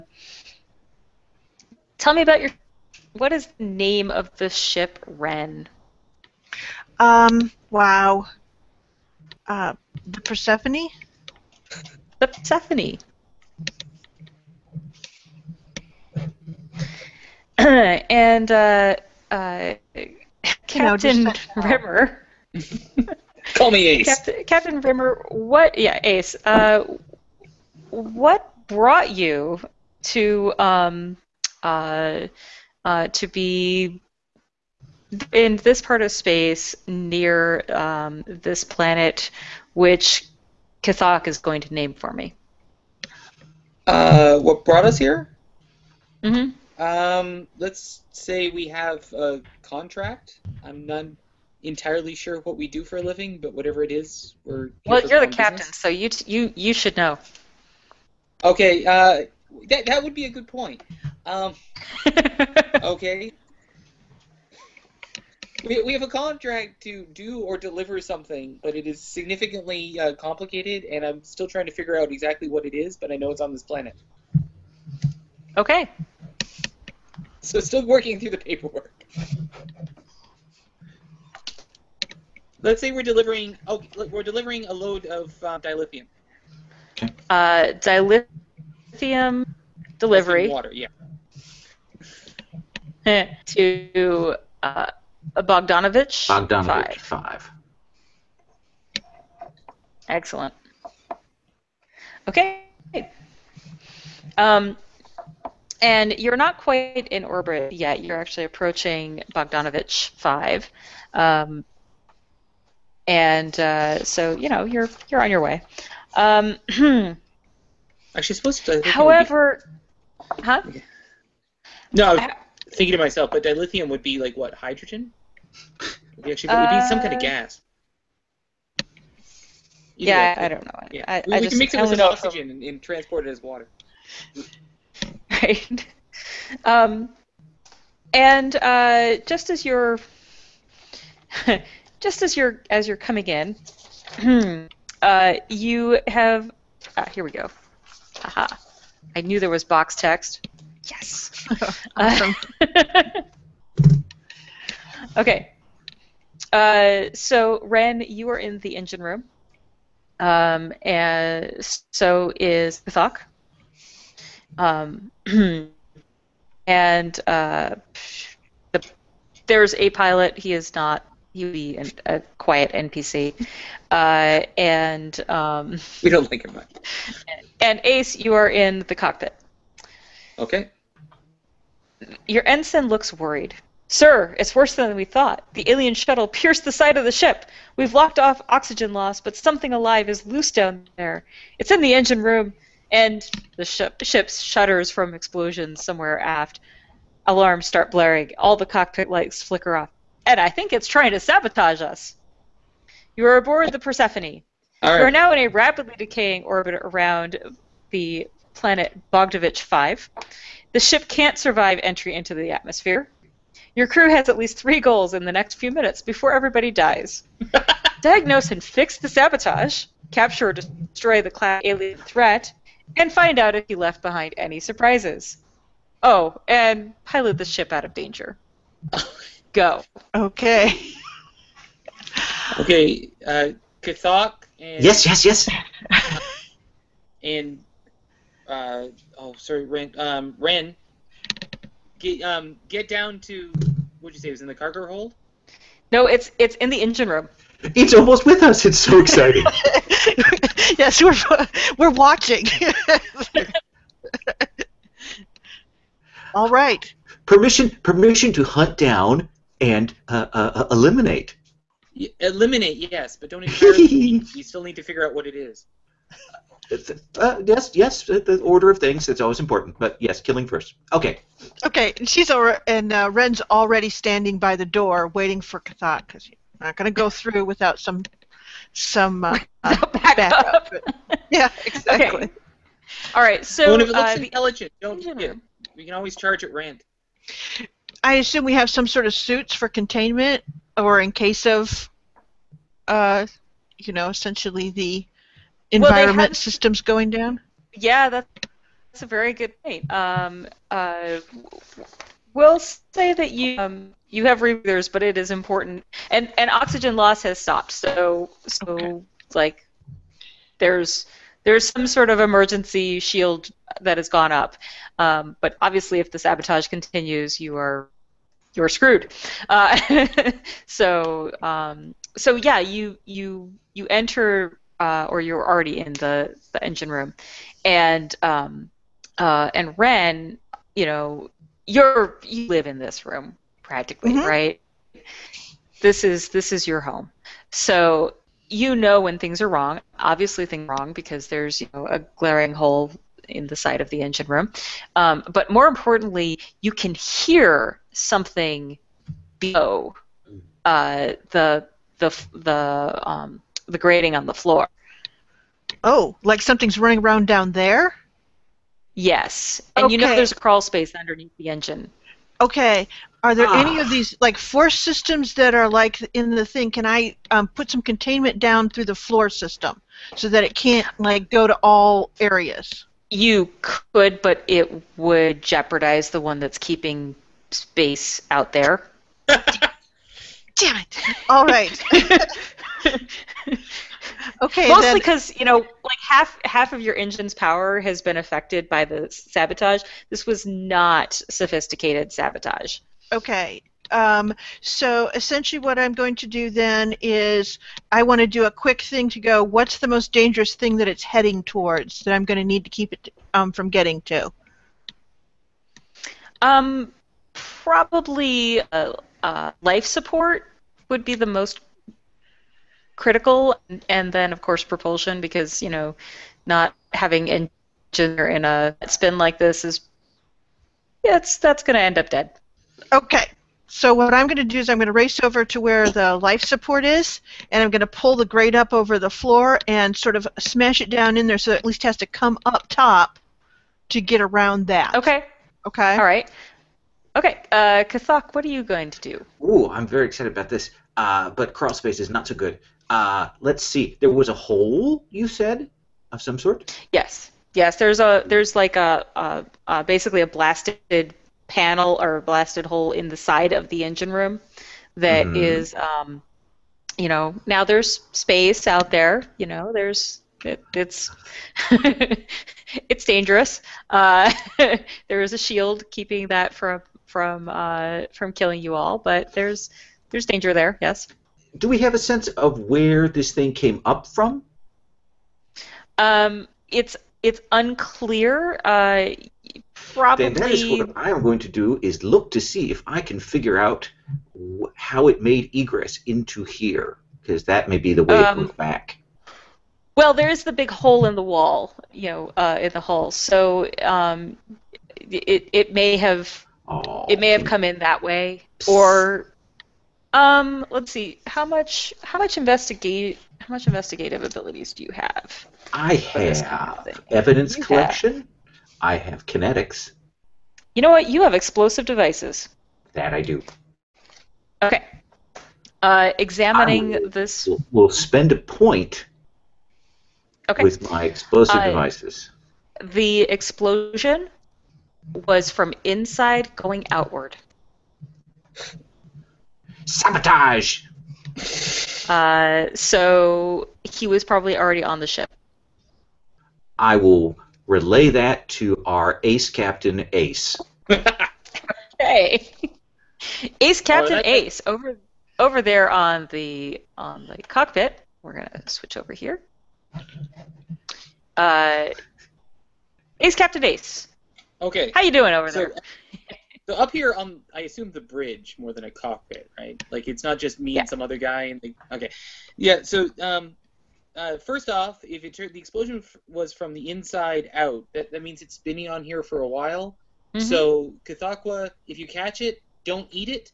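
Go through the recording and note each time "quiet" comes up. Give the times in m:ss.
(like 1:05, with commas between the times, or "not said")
2:52.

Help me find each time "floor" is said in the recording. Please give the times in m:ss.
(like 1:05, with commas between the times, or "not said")
5:54, 6:08, 7:09.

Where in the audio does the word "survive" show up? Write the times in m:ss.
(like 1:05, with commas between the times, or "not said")
3:31.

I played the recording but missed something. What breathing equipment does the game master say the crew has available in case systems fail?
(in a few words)
Rebreathers.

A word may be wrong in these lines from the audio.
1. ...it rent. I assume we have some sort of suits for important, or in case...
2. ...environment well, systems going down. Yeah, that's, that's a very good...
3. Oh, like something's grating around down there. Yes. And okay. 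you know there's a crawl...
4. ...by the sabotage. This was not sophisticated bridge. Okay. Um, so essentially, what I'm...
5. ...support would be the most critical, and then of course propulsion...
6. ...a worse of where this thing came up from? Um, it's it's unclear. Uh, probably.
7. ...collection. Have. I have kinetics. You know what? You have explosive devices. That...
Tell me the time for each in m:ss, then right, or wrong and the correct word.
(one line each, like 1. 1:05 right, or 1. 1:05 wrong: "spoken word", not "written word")
1. 4:46 wrong: "containment", not "important"
2. 4:55 right
3. 5:55 wrong: "running", not "grating"
4. 6:28 wrong: "sabotage", not "bridge"
5. 6:49 right
6. 7:51 wrong: "sense", not "worse"
7. 8:27 right.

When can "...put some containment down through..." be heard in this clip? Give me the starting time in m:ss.
6:07.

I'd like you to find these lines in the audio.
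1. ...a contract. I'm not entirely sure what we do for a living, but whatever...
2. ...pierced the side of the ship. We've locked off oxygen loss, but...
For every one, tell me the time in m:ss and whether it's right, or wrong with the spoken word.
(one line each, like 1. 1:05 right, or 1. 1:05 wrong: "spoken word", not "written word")
1. 0:49 right
2. 3:06 right.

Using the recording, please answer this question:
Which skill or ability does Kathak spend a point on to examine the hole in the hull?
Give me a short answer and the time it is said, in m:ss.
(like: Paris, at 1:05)
Explosive devices, at 8:41.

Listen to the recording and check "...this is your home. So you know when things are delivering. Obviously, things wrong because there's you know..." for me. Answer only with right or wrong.
wrong.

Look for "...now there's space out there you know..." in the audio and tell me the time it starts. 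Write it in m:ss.
7:37.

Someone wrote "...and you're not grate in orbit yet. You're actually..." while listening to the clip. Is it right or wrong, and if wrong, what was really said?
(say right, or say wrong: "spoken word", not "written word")
wrong: "quite", not "grate".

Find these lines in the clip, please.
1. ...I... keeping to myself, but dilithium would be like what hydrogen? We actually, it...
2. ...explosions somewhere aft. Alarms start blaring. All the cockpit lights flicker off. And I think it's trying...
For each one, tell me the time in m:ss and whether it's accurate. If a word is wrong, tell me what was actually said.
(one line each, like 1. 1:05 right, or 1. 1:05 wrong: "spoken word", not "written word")
1. 2:02 wrong: "thinking", not "keeping"
2. 3:15 right.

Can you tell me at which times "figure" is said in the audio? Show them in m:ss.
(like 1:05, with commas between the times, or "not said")
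1:11, 4:24, 8:03.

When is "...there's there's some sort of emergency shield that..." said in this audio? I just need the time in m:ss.
5:10.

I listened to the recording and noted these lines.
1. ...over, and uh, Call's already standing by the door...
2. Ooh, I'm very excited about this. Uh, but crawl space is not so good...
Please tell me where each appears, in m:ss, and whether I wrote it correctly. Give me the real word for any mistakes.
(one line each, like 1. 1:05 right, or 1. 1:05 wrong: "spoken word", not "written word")
1. 4:32 wrong: "Ren", not "Call"
2. 7:19 right.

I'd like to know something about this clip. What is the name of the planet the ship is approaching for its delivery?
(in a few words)
Bogdanovich 5.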